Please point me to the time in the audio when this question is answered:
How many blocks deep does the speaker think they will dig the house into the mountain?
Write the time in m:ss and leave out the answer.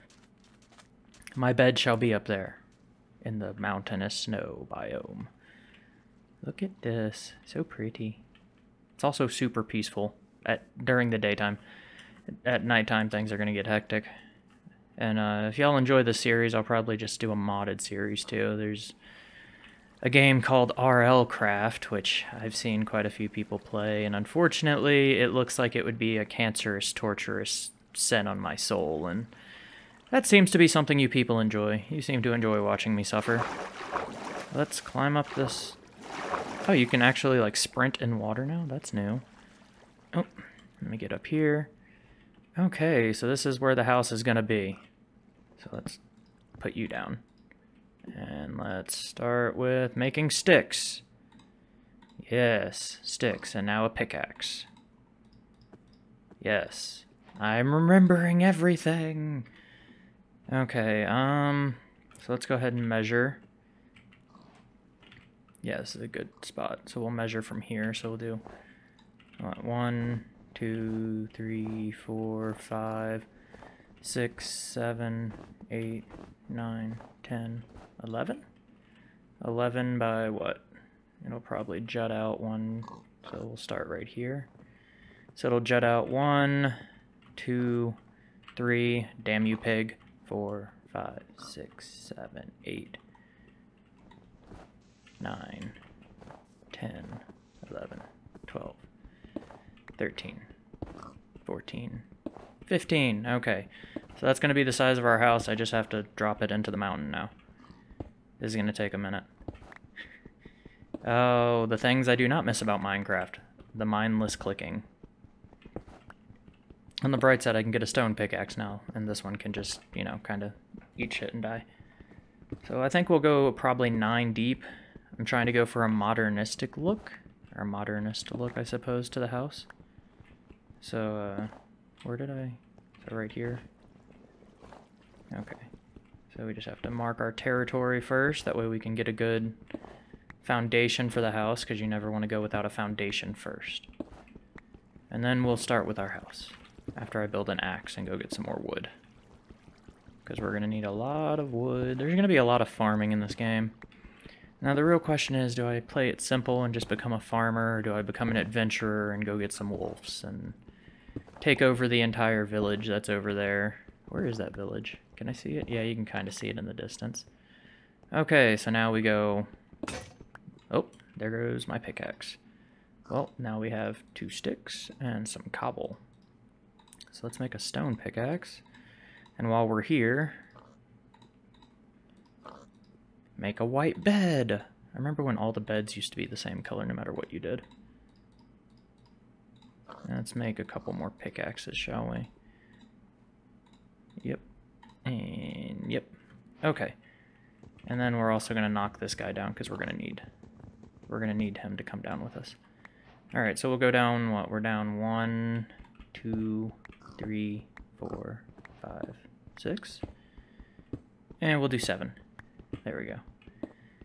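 2:03.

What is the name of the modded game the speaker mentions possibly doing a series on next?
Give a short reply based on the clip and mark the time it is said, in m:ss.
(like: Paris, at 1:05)
RL Craft, at 0:20.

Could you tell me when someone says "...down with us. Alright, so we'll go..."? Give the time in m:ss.
3:22.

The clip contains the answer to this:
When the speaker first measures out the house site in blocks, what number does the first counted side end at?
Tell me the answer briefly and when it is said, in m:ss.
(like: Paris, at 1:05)
11, at 1:18.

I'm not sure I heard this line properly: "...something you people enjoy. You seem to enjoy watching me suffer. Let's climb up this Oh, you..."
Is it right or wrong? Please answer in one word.
right.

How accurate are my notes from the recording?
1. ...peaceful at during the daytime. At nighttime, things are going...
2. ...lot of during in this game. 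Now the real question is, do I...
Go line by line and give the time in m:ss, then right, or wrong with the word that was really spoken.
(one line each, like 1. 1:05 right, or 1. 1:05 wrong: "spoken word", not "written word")
1. 0:09 right
2. 2:32 wrong: "farming", not "during".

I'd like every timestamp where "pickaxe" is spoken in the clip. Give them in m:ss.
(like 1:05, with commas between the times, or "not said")
0:53, 1:58, 2:51, 2:57, 3:11.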